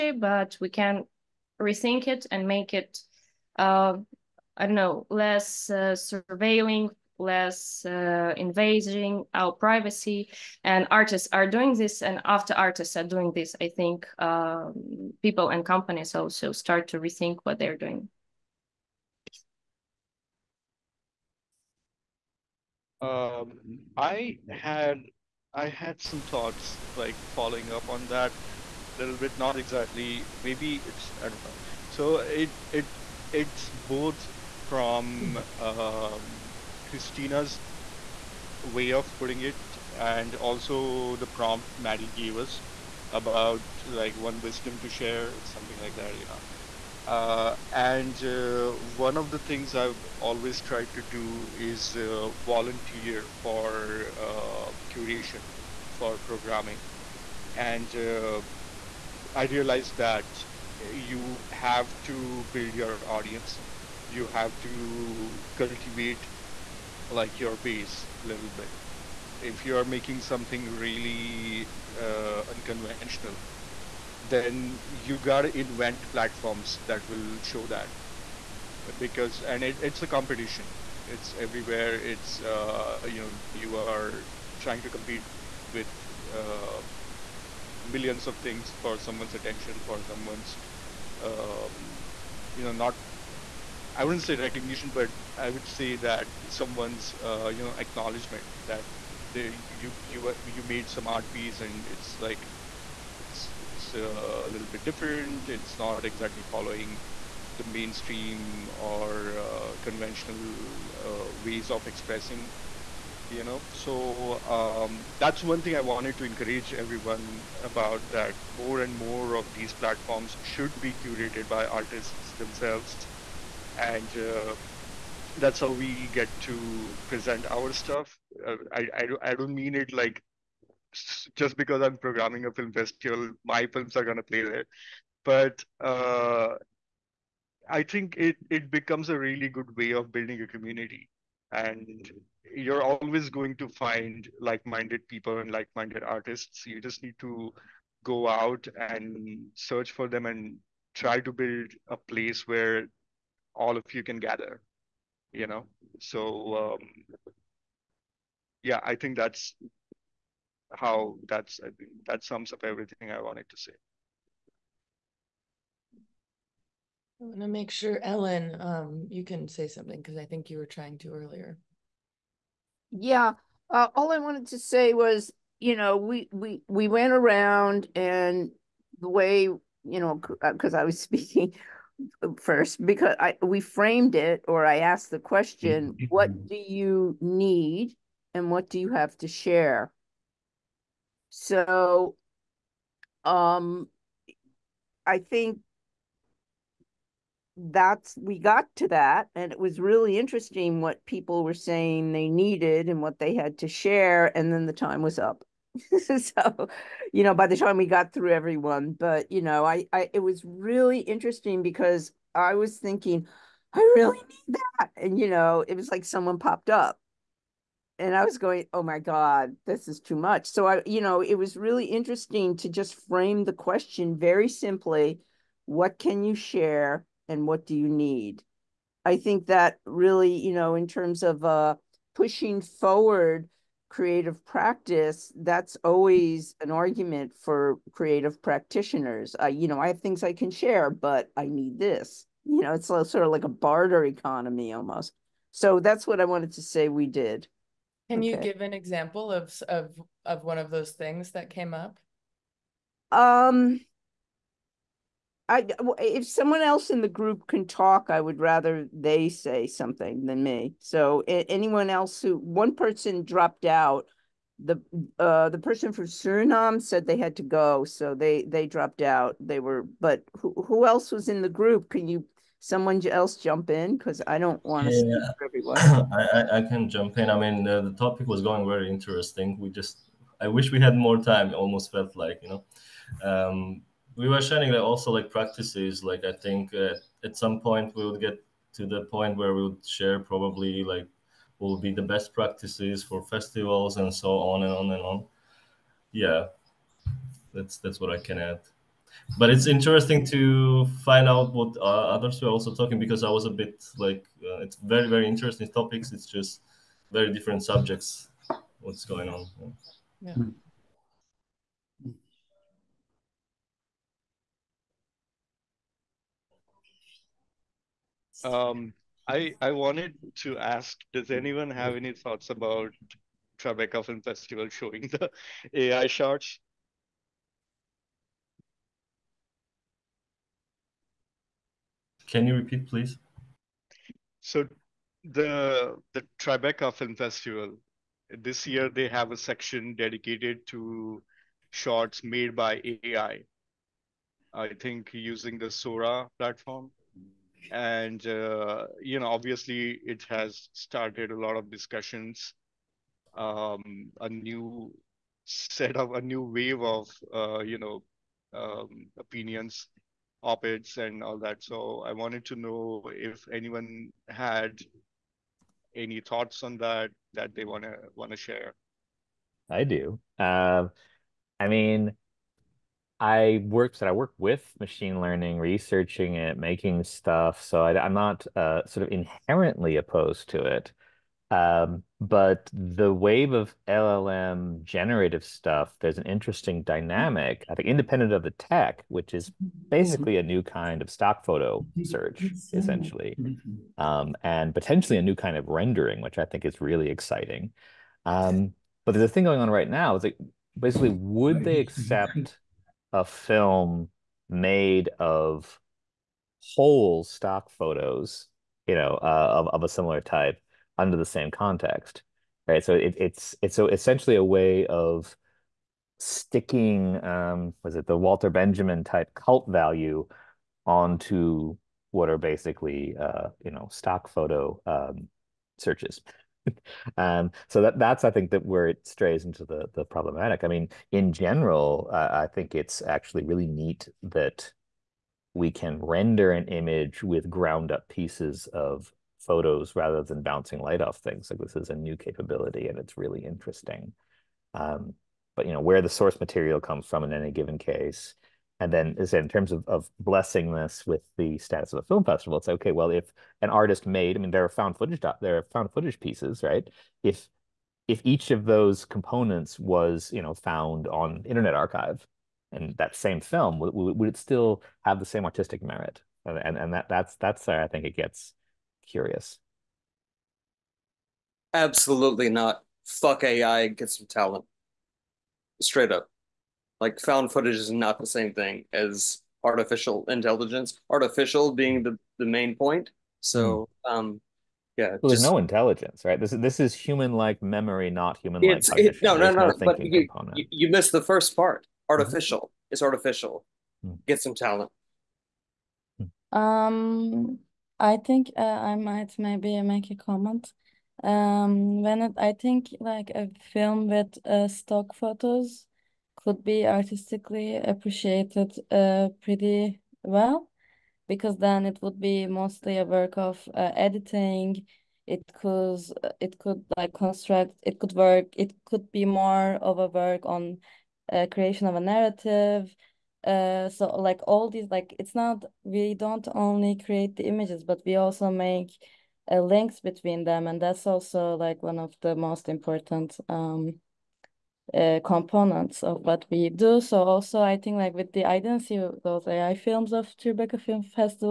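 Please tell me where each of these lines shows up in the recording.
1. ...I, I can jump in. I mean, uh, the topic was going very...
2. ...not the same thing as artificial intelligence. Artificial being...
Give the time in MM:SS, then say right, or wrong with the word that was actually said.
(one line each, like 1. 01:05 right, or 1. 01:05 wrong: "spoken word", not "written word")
1. 04:36 right
2. 07:57 right.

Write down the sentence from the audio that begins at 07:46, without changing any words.
And and, and that that's that's where I think it gets curious.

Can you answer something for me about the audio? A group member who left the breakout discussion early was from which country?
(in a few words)
Suriname.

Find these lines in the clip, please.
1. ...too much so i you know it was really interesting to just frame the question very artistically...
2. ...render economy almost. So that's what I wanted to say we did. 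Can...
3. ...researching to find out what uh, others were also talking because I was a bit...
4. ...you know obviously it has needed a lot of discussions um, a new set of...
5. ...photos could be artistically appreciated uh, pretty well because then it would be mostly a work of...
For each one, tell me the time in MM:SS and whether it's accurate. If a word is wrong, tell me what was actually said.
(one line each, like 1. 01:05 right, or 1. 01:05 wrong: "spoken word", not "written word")
1. 03:40 wrong: "simply", not "artistically"
2. 04:03 wrong: "barter", not "render"
3. 04:59 wrong: "interesting", not "researching"
4. 05:49 wrong: "started", not "needed"
5. 08:25 right.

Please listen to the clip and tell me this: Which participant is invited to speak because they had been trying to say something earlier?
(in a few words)
Ellen.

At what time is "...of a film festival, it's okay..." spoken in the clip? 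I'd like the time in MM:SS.
07:31.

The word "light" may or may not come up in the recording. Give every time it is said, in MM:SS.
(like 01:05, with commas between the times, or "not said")
07:20.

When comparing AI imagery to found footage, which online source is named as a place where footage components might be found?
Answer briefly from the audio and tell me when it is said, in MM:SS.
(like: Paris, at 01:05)
Internet Archive, at 07:41.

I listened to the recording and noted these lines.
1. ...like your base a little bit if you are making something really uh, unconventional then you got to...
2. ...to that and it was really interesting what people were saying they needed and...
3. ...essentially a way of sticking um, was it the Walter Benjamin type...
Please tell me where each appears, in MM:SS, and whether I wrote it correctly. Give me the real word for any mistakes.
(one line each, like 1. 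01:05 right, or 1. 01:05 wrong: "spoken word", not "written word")
1. 01:07 right
2. 03:18 right
3. 06:53 right.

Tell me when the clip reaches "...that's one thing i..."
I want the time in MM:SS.
01:55.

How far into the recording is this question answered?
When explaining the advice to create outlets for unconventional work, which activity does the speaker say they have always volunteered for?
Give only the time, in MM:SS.
00:54.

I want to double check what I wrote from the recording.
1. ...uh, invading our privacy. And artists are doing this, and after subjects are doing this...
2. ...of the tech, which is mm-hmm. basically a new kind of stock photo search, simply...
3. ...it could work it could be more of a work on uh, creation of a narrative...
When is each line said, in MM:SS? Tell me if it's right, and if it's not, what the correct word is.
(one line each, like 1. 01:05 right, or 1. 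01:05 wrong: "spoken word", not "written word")
1. 00:07 wrong: "artists", not "subjects"
2. 06:28 wrong: "essentially", not "simply"
3. 08:37 right.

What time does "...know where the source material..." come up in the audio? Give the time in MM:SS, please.
07:25.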